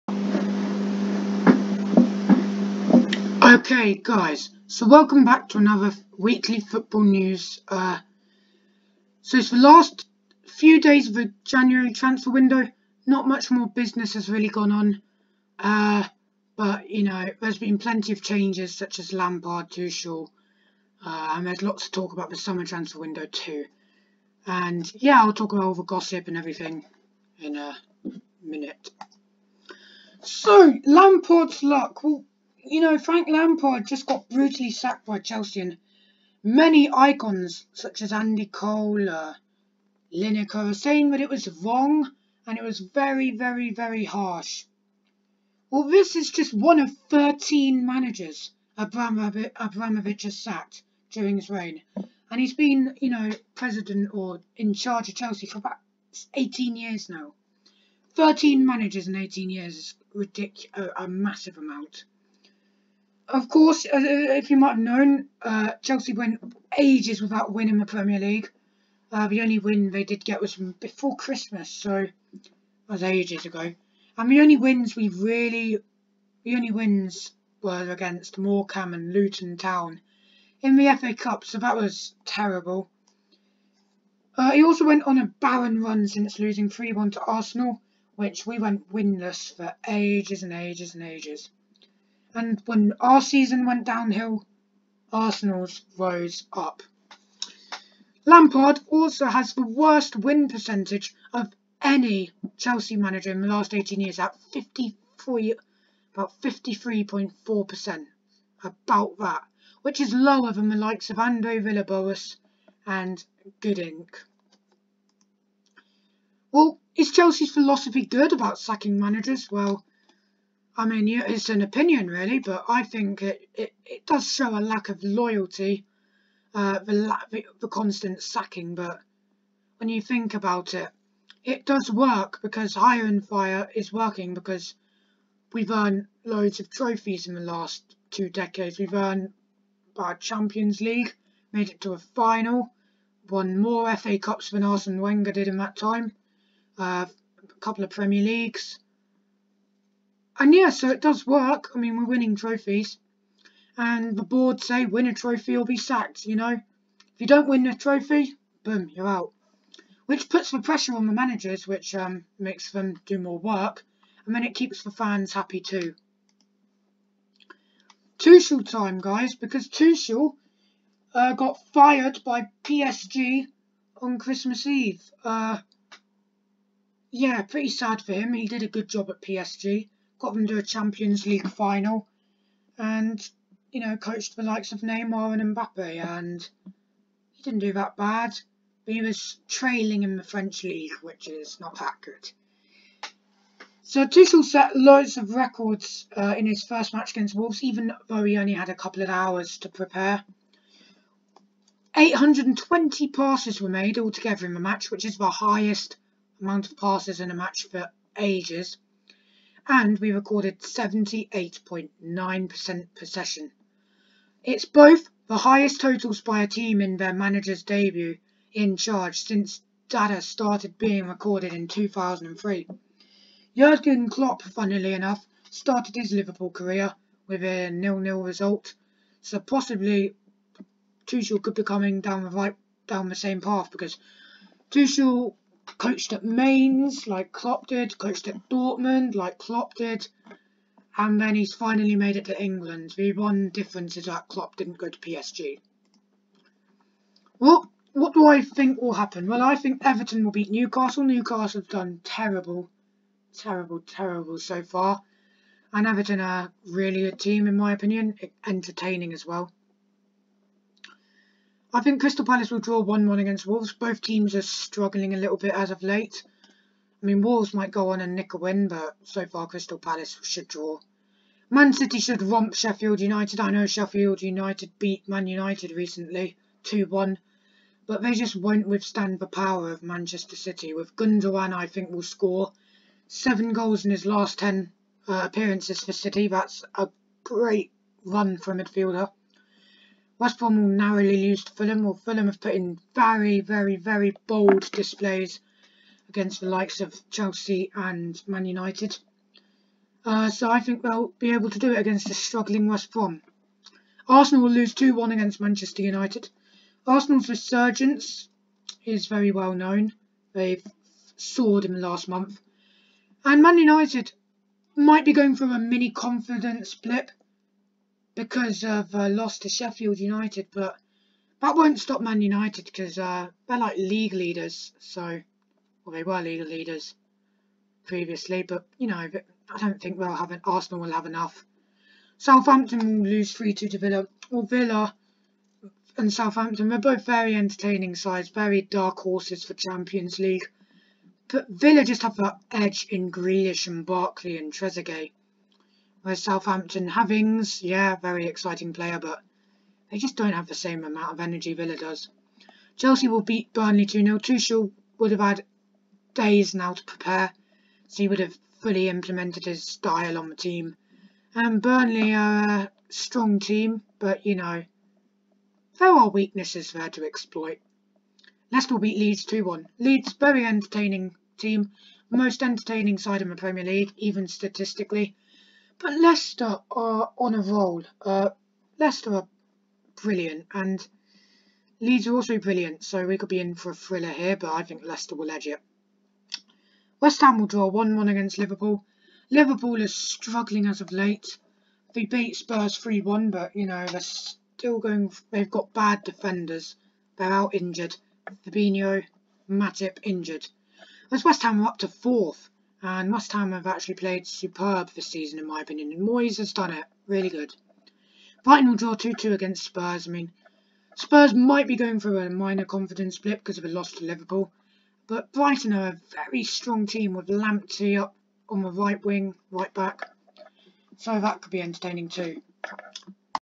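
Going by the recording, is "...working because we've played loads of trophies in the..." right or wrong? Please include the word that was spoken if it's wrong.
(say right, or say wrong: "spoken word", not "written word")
wrong: "earned", not "played".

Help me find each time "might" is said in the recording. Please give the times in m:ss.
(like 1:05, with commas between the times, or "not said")
1:04, 4:27, 5:14, 6:51.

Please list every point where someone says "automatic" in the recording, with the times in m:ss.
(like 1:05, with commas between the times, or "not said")
not said.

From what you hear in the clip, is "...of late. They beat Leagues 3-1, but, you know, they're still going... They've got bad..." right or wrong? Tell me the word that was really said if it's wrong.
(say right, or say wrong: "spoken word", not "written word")
wrong: "Spurs", not "Leagues".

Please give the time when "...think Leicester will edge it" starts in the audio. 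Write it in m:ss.
6:24.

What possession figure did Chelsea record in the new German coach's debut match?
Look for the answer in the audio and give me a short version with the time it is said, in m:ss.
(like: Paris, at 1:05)
78.9%, at 3:30.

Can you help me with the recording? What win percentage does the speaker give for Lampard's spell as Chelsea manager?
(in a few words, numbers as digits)
53.4%.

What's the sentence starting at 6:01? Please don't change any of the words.
And Burnley are a strong team, but, you know, there are weaknesses there to exploit.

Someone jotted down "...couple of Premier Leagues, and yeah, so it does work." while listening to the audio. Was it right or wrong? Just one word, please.
right.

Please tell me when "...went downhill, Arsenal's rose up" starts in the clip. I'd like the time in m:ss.
1:33.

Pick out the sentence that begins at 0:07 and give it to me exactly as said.
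Uh, so it's the last few days of the January transfer window.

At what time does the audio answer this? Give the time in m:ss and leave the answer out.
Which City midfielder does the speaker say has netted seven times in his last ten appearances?
4:40.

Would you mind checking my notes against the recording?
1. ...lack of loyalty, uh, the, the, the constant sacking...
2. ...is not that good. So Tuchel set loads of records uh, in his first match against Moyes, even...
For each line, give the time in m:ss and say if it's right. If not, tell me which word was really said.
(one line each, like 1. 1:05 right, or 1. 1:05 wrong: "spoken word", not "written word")
1. 2:04 right
2. 3:11 wrong: "Wolves", not "Moyes".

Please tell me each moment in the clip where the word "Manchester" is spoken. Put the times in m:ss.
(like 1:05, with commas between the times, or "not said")
4:39, 5:05.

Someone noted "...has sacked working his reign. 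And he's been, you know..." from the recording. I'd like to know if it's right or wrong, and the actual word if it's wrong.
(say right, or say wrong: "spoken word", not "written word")
wrong: "during", not "working".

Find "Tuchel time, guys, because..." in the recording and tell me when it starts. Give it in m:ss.
2:48.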